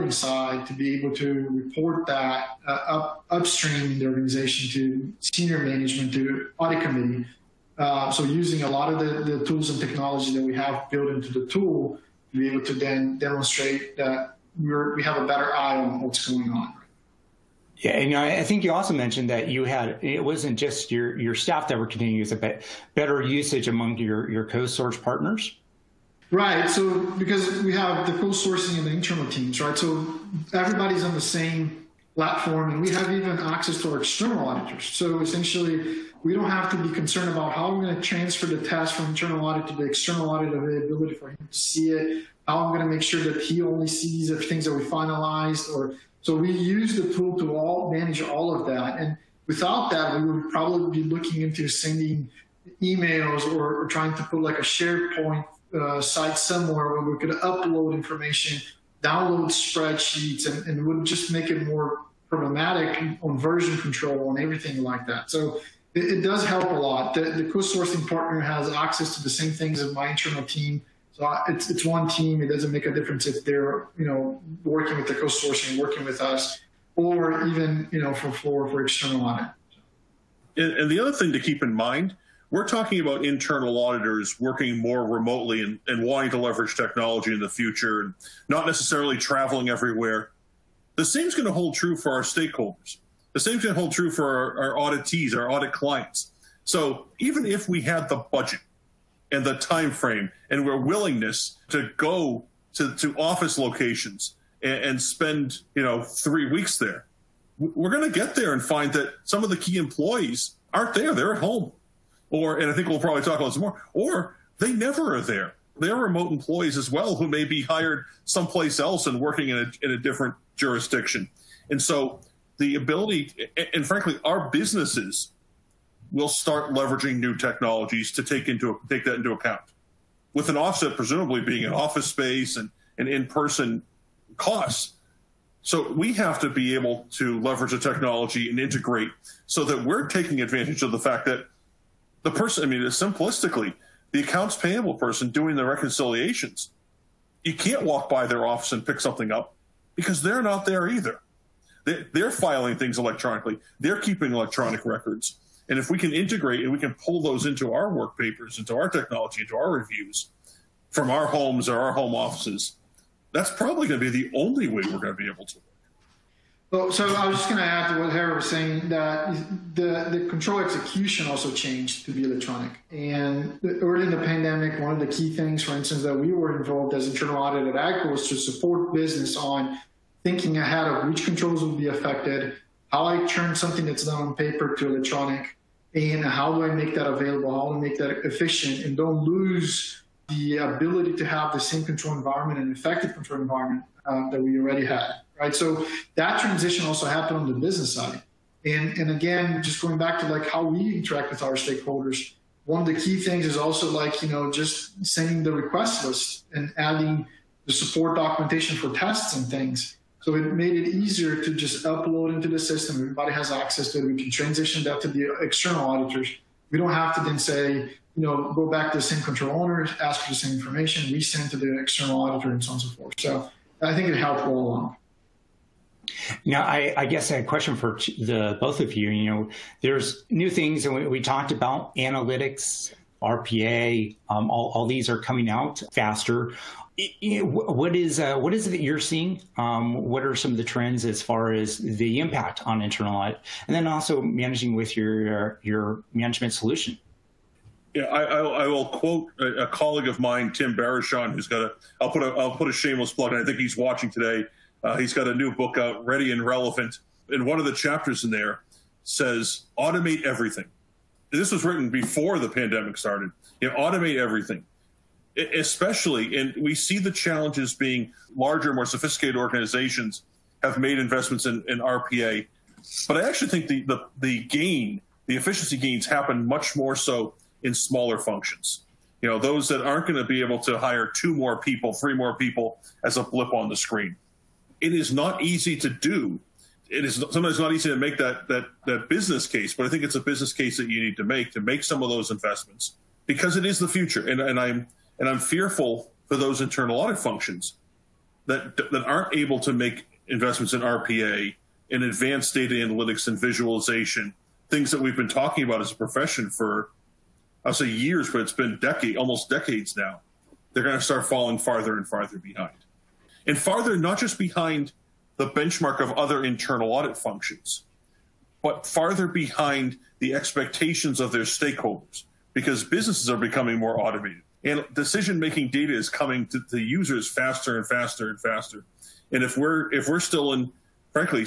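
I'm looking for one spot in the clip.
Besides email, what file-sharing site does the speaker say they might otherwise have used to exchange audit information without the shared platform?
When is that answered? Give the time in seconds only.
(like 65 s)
54 s.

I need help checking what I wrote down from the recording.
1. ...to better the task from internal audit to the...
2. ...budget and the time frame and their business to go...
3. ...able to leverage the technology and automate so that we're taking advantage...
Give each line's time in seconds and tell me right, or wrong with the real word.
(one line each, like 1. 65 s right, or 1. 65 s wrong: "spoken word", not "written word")
1. 37 s wrong: "transfer", not "better"
2. 98 s wrong: "willingness", not "business"
3. 136 s wrong: "integrate", not "automate".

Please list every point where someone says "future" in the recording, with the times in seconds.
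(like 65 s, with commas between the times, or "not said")
87 s, 293 s.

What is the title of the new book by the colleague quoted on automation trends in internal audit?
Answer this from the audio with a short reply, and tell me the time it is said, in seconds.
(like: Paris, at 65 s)
Ready and Relevant, at 256 s.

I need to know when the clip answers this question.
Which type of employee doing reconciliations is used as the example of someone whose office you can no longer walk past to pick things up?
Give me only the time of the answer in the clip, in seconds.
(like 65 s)
144 s.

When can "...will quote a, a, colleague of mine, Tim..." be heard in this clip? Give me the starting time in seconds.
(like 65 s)
248 s.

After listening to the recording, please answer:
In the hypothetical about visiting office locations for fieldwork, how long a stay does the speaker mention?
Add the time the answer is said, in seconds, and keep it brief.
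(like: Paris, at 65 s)
3 weeks, at 106 s.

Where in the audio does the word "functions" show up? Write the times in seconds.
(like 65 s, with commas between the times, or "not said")
278 s, 297 s, 317 s.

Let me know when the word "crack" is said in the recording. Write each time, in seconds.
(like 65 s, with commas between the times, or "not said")
not said.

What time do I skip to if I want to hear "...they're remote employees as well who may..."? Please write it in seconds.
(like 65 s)
115 s.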